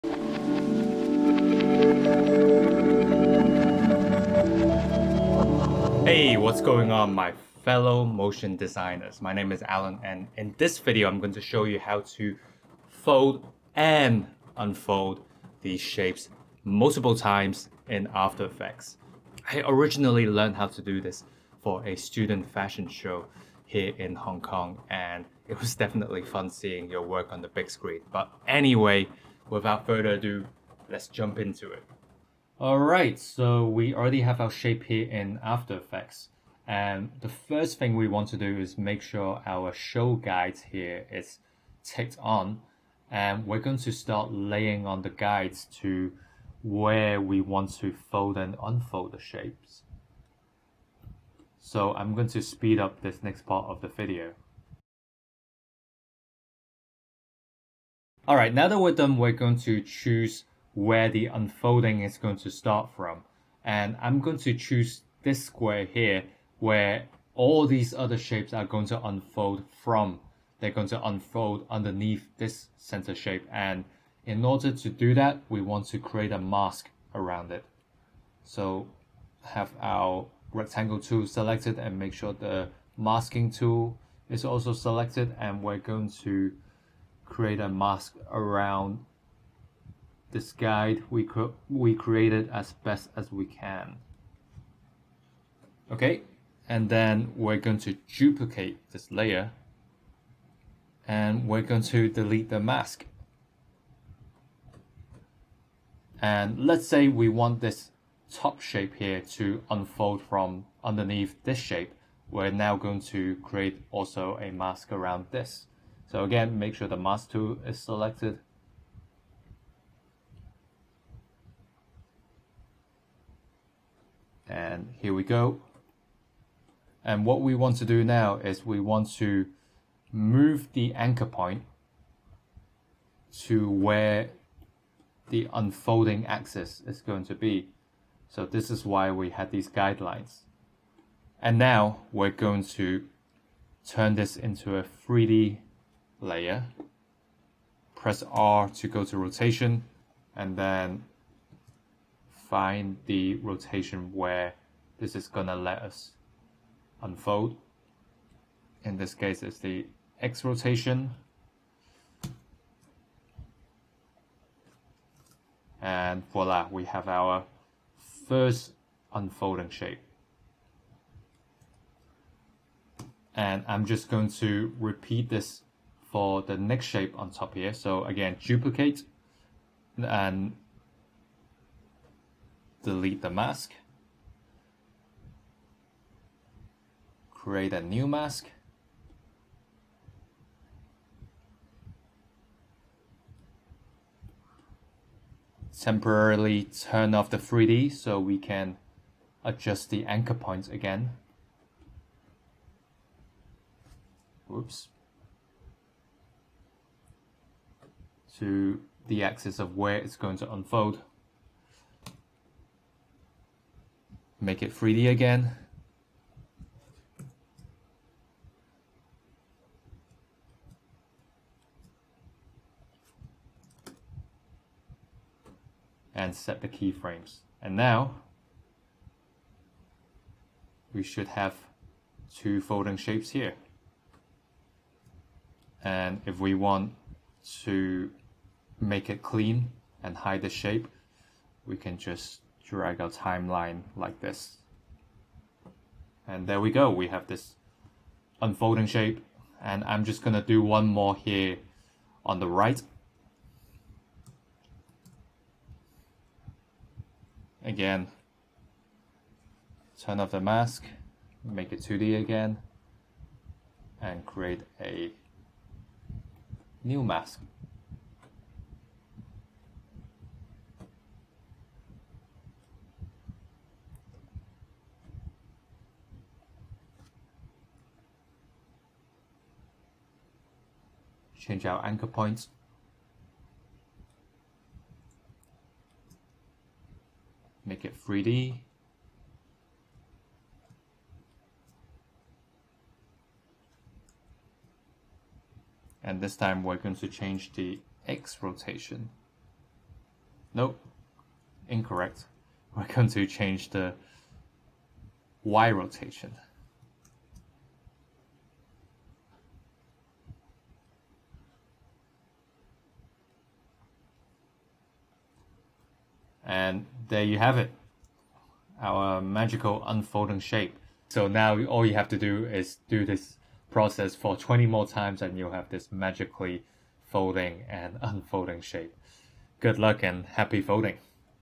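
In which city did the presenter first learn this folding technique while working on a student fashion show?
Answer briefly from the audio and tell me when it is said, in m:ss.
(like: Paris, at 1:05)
Hong Kong, at 0:24.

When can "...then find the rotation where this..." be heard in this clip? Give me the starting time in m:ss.
2:30.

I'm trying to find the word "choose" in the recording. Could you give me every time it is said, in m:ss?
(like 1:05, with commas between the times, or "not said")
0:59, 1:04.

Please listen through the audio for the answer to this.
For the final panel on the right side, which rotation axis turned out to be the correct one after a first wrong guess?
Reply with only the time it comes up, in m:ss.
5:05.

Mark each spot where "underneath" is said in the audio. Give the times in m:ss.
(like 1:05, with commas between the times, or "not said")
1:11, 1:50.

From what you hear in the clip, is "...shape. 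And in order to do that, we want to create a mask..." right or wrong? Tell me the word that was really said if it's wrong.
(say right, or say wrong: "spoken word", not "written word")
right.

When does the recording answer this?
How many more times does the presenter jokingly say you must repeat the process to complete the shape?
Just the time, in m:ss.
5:24.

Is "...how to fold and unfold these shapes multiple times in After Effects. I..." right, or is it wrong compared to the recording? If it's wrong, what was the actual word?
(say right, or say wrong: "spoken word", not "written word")
right.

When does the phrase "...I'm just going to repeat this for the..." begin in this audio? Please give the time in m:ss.
2:53.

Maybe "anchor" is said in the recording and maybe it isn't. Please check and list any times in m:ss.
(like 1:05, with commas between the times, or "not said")
2:10, 3:20, 4:41.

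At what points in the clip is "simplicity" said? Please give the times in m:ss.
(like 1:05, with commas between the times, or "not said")
not said.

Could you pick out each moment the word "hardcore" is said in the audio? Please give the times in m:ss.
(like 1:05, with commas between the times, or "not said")
not said.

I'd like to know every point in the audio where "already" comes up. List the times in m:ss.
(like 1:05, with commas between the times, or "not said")
0:33.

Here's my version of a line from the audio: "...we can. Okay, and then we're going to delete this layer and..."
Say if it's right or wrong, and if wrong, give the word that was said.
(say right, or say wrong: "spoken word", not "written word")
wrong: "duplicate", not "delete".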